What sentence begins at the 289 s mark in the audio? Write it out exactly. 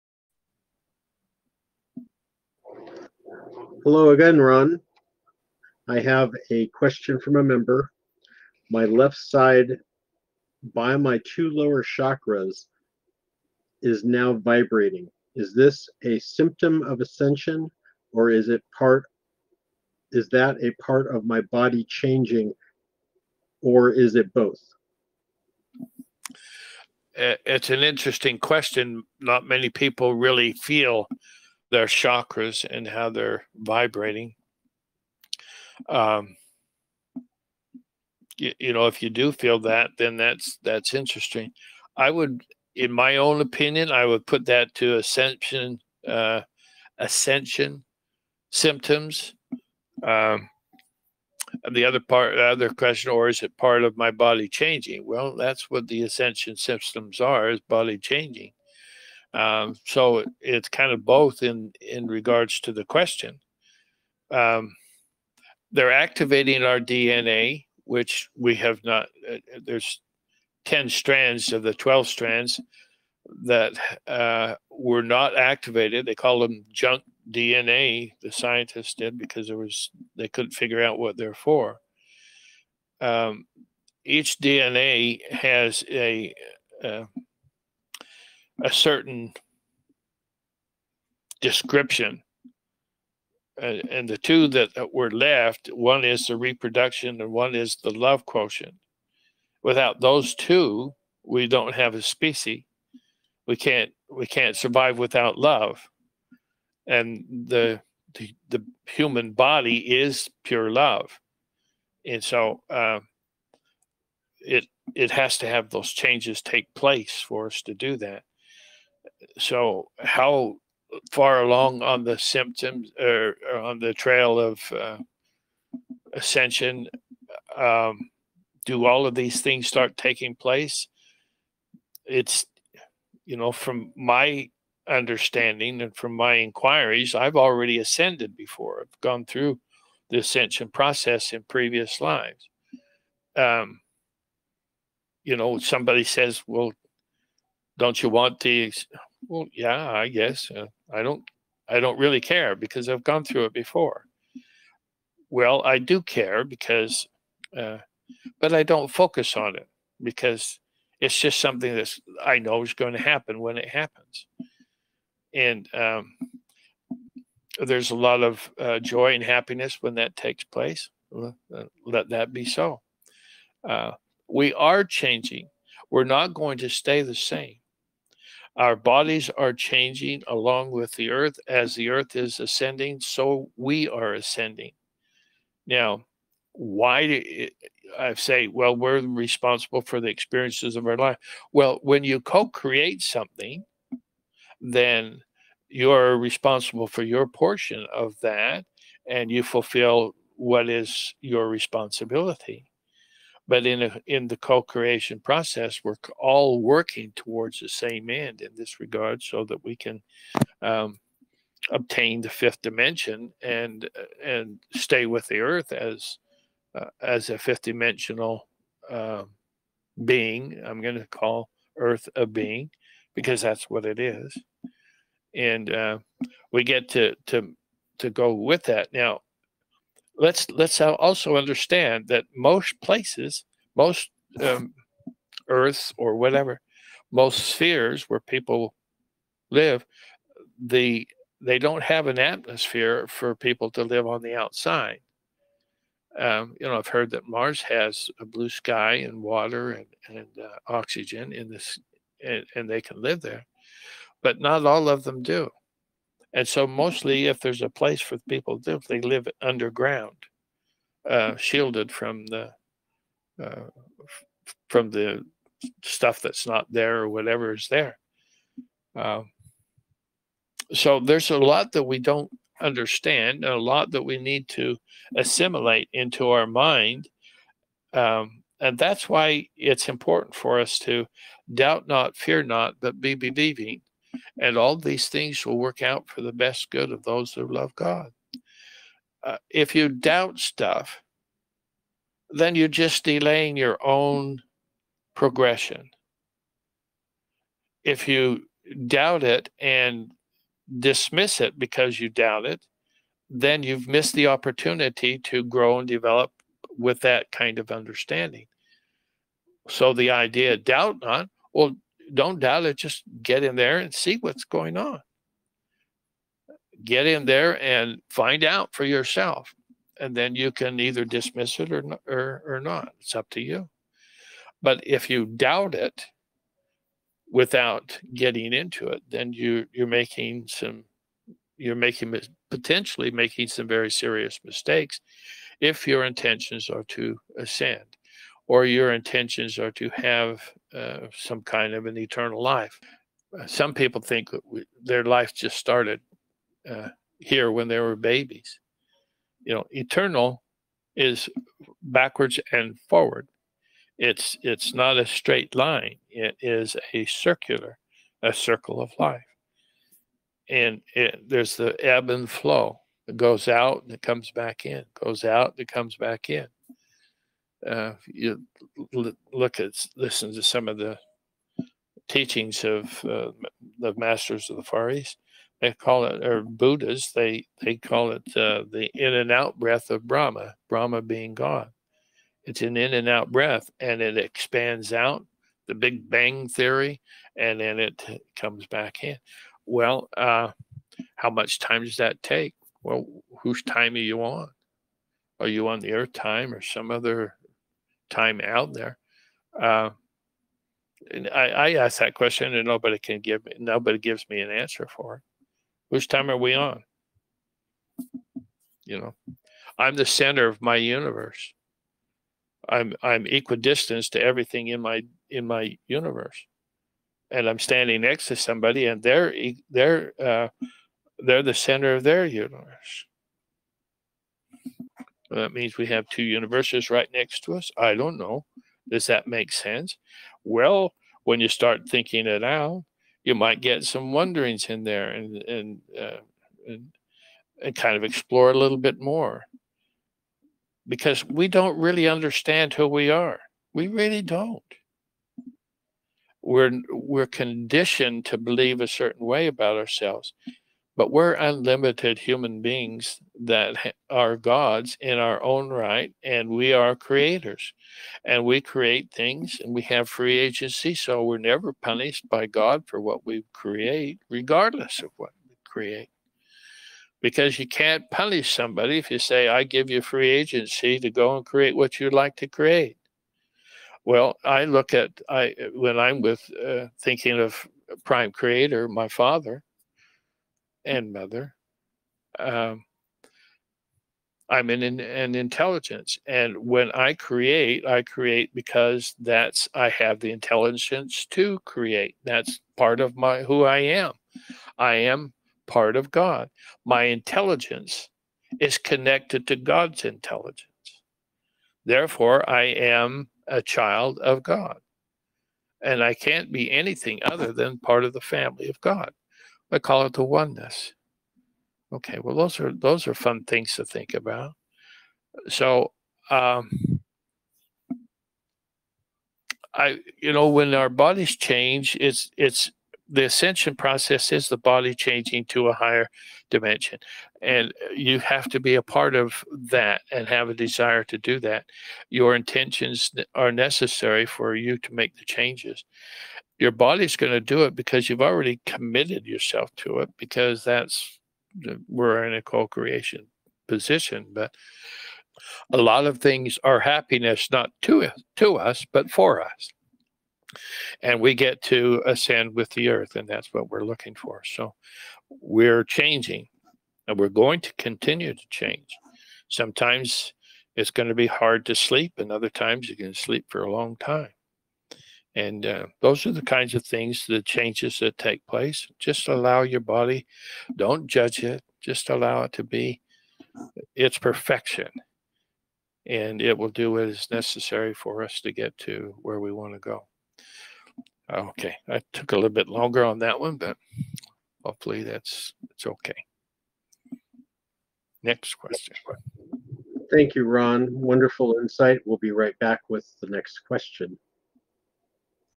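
Uh, if you doubt stuff, then you're just delaying your own progression.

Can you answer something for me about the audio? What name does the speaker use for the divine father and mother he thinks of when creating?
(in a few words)
Prime Creator.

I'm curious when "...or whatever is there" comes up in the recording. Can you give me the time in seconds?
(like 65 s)
267 s.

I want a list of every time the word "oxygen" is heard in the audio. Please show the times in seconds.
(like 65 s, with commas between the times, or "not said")
250 s.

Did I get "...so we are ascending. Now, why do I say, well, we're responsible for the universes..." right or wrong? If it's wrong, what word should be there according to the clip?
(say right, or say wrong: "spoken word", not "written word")
wrong: "experiences", not "universes".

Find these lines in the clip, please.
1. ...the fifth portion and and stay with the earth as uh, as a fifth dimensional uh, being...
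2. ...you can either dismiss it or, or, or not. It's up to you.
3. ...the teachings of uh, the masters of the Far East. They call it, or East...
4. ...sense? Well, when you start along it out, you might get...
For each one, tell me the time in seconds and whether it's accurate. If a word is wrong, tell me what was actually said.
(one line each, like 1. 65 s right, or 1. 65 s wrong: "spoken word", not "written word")
1. 212 s wrong: "dimension", not "portion"
2. 320 s right
3. 370 s wrong: "Buddhas", not "East"
4. 429 s wrong: "thinking", not "along".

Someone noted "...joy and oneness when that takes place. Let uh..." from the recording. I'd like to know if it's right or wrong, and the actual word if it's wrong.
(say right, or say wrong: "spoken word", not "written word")
wrong: "happiness", not "oneness".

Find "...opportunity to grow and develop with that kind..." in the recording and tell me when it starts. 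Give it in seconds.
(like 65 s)
304 s.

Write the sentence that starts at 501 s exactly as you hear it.
Therefore, I am a child of God.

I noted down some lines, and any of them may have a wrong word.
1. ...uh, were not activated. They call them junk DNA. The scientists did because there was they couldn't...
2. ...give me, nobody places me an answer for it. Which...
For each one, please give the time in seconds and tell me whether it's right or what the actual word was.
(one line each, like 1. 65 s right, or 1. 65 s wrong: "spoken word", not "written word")
1. 74 s right
2. 403 s wrong: "gives", not "places".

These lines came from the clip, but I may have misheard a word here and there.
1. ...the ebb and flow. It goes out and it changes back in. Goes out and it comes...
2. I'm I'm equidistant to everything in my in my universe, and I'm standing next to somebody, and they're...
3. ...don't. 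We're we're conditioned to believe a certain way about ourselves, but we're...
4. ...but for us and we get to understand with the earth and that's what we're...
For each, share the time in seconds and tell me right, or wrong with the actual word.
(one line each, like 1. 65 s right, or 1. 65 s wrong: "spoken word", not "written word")
1. 361 s wrong: "comes", not "changes"
2. 412 s right
3. 444 s right
4. 548 s wrong: "ascend", not "understand".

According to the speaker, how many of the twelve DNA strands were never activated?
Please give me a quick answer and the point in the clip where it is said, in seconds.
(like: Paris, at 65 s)
10, at 70 s.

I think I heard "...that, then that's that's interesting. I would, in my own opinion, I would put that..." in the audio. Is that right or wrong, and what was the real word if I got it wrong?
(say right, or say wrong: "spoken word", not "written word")
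right.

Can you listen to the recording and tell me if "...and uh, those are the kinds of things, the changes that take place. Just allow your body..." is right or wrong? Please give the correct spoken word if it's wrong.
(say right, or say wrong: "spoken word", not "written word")
right.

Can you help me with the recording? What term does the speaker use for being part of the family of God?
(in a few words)
The oneness.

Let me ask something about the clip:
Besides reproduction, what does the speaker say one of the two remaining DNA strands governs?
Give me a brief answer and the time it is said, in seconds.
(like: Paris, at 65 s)
The love quotient, at 97 s.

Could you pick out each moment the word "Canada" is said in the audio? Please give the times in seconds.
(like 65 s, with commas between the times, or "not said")
not said.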